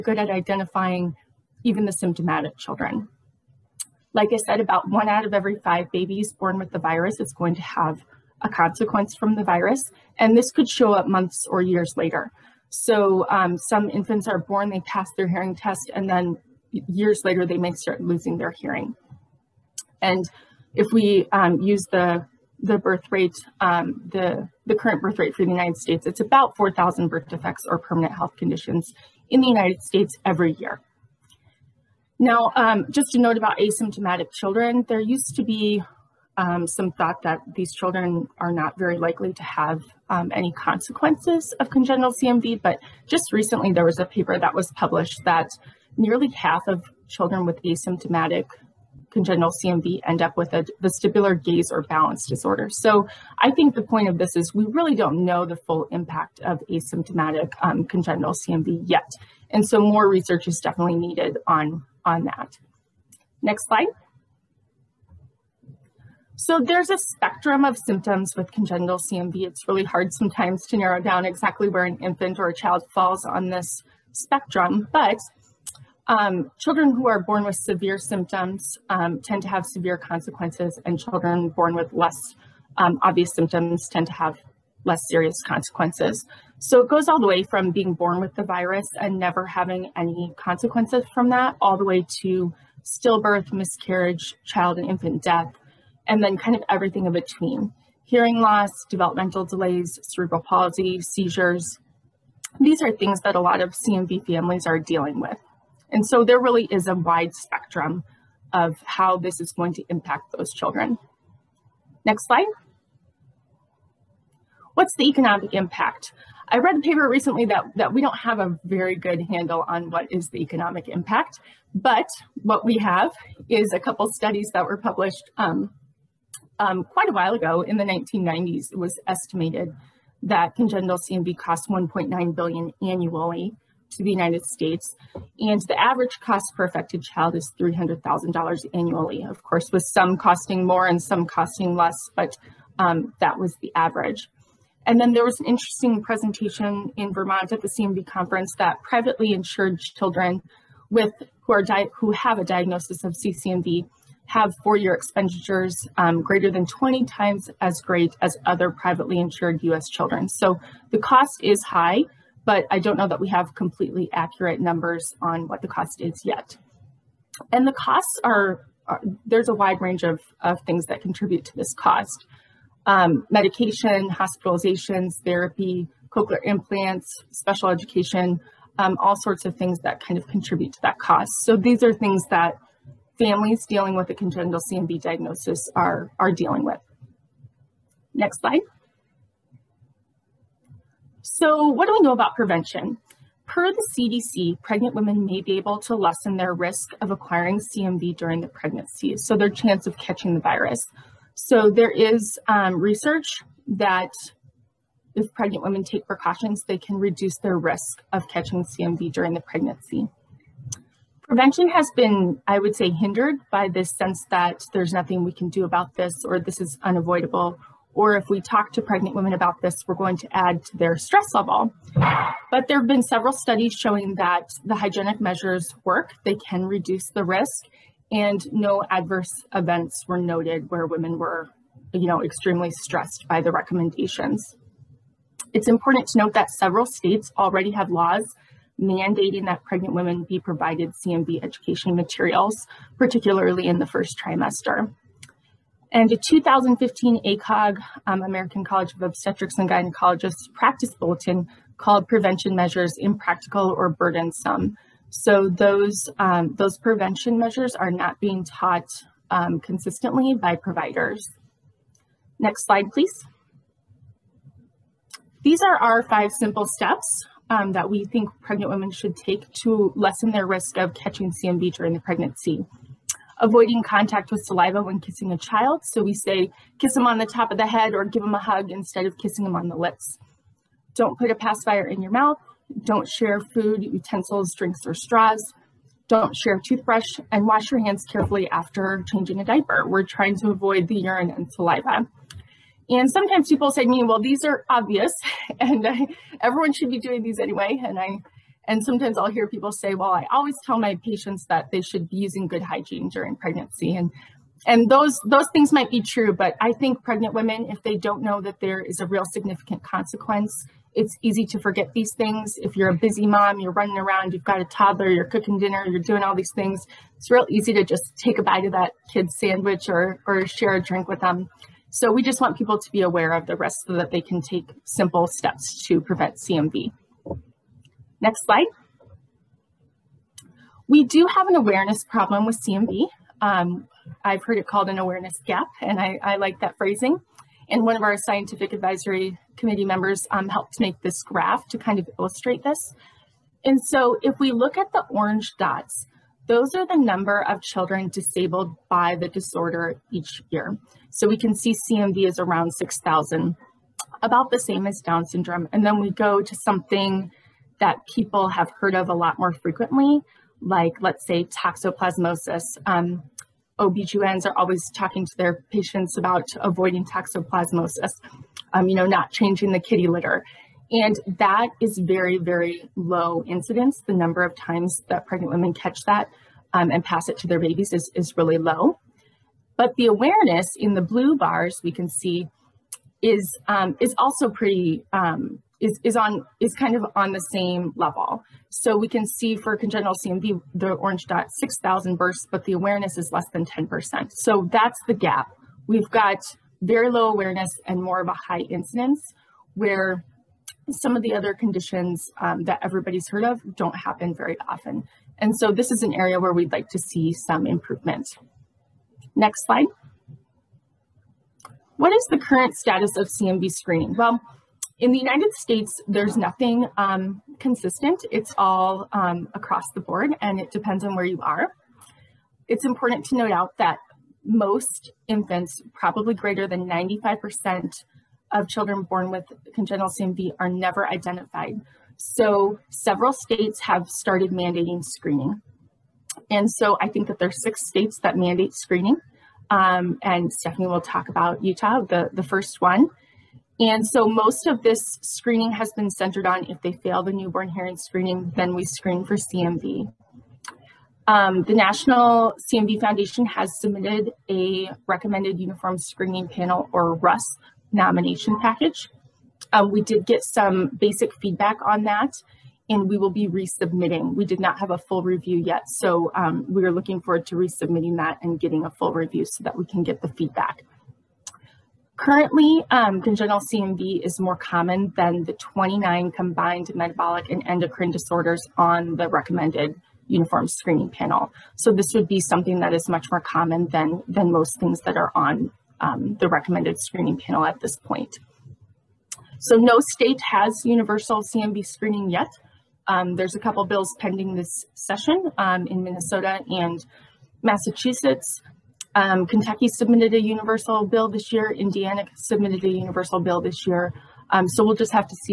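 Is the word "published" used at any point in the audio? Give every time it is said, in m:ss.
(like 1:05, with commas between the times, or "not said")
0:44, 2:04.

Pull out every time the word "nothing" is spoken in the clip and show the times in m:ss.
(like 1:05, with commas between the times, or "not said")
3:34, 6:56.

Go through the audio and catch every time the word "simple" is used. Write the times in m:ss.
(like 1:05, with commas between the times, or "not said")
4:26, 5:24.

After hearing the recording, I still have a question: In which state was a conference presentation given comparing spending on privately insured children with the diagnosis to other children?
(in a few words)
Vermont.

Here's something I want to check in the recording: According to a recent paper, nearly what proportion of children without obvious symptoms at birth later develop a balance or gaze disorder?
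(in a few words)
half.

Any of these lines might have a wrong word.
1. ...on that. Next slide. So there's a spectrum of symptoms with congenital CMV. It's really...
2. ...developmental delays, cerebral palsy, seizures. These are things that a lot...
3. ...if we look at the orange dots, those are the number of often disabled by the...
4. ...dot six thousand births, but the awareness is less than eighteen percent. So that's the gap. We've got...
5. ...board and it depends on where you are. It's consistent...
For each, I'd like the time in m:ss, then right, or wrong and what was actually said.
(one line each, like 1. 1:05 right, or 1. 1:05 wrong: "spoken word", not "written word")
1. 1:02 right
2. 1:38 right
3. 5:44 wrong: "children", not "often"
4. 6:31 wrong: "ten", not "eighteen"
5. 6:59 wrong: "important", not "consistent".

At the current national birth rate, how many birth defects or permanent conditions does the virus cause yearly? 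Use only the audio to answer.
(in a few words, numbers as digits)
4,000.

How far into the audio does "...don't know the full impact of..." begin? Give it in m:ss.
0:54.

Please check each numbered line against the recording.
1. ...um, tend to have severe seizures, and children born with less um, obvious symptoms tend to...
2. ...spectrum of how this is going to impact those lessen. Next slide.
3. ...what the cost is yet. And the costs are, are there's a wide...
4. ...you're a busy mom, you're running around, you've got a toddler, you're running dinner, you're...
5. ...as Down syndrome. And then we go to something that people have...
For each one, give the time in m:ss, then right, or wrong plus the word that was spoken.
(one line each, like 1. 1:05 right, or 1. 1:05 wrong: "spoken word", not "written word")
1. 1:18 wrong: "consequences", not "seizures"
2. 1:47 wrong: "children", not "lessen"
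3. 2:45 right
4. 5:12 wrong: "cooking", not "running"
5. 5:54 right.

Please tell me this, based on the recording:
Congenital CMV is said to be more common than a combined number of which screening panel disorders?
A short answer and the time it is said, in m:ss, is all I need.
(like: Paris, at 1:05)
29, at 7:55.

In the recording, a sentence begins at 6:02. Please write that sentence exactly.
Um, OBGYNs are always talking to their patients about avoiding toxoplasmosis, um, you know, not changing the kitty litter.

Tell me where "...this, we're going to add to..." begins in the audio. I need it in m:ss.
3:39.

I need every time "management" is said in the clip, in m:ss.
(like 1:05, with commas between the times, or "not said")
not said.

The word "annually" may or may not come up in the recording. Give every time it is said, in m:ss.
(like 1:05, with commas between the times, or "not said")
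2:12, 2:18.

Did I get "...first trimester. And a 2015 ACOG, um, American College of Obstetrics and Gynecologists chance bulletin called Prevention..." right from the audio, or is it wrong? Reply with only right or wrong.
wrong.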